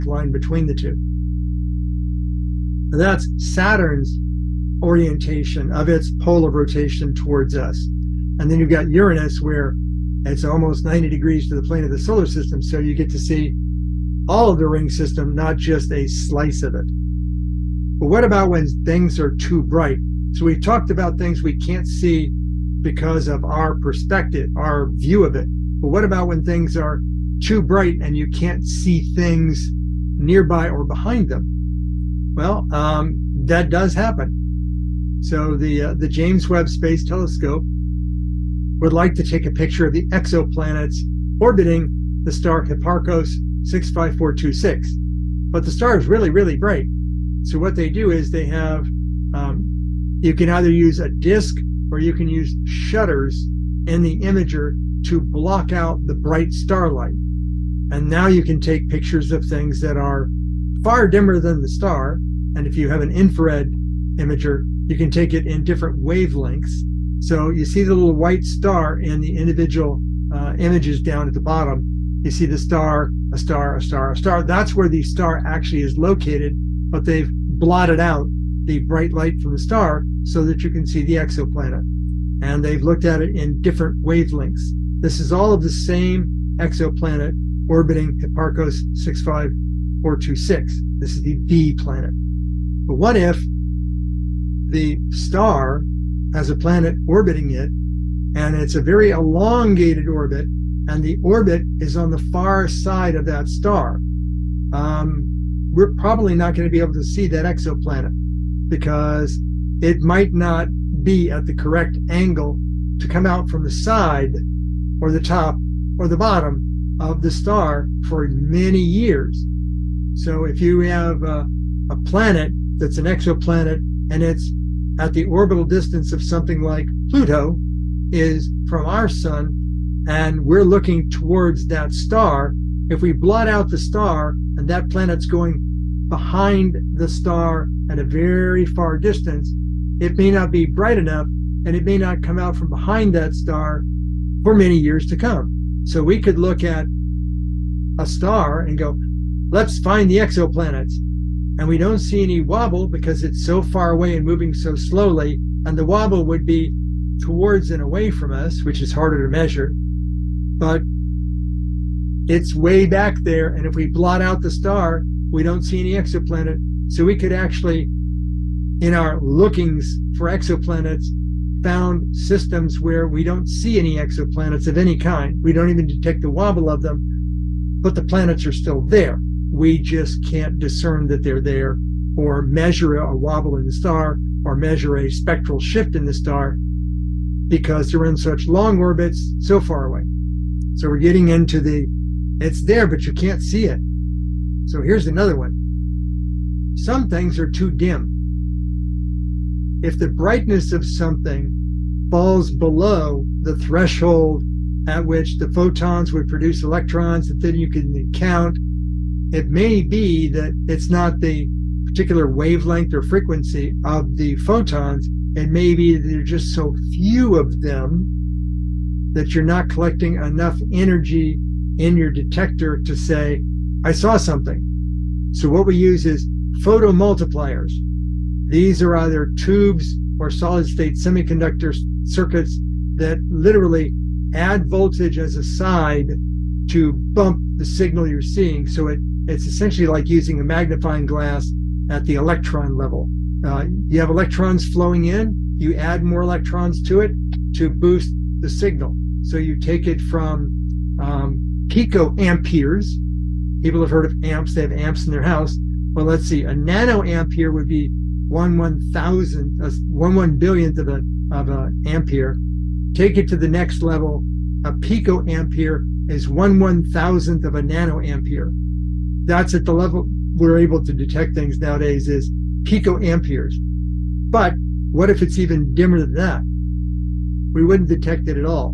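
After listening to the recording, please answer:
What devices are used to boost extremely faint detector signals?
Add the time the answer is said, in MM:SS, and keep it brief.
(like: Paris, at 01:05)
Photomultipliers, at 03:46.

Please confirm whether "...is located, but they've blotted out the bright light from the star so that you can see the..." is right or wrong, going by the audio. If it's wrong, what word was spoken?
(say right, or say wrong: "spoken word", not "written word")
right.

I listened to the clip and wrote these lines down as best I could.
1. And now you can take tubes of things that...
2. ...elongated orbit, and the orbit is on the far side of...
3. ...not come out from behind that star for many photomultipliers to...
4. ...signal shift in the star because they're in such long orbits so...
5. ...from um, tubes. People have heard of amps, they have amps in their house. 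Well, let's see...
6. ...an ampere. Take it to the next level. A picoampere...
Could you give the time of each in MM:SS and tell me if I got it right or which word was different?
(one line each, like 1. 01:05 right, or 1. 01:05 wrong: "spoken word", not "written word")
1. 00:57 wrong: "pictures", not "tubes"
2. 01:39 right
3. 02:21 wrong: "years", not "photomultipliers"
4. 03:05 wrong: "spectral", not "signal"
5. 04:10 wrong: "picoamperes", not "tubes"
6. 04:21 right.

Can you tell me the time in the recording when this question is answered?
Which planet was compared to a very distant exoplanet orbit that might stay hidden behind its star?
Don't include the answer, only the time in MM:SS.
02:07.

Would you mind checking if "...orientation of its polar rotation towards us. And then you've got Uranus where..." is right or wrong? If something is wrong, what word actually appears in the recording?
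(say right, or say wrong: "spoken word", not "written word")
right.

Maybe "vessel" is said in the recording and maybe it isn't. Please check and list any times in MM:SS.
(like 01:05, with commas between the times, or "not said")
not said.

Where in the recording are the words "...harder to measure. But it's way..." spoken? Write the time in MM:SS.
02:38.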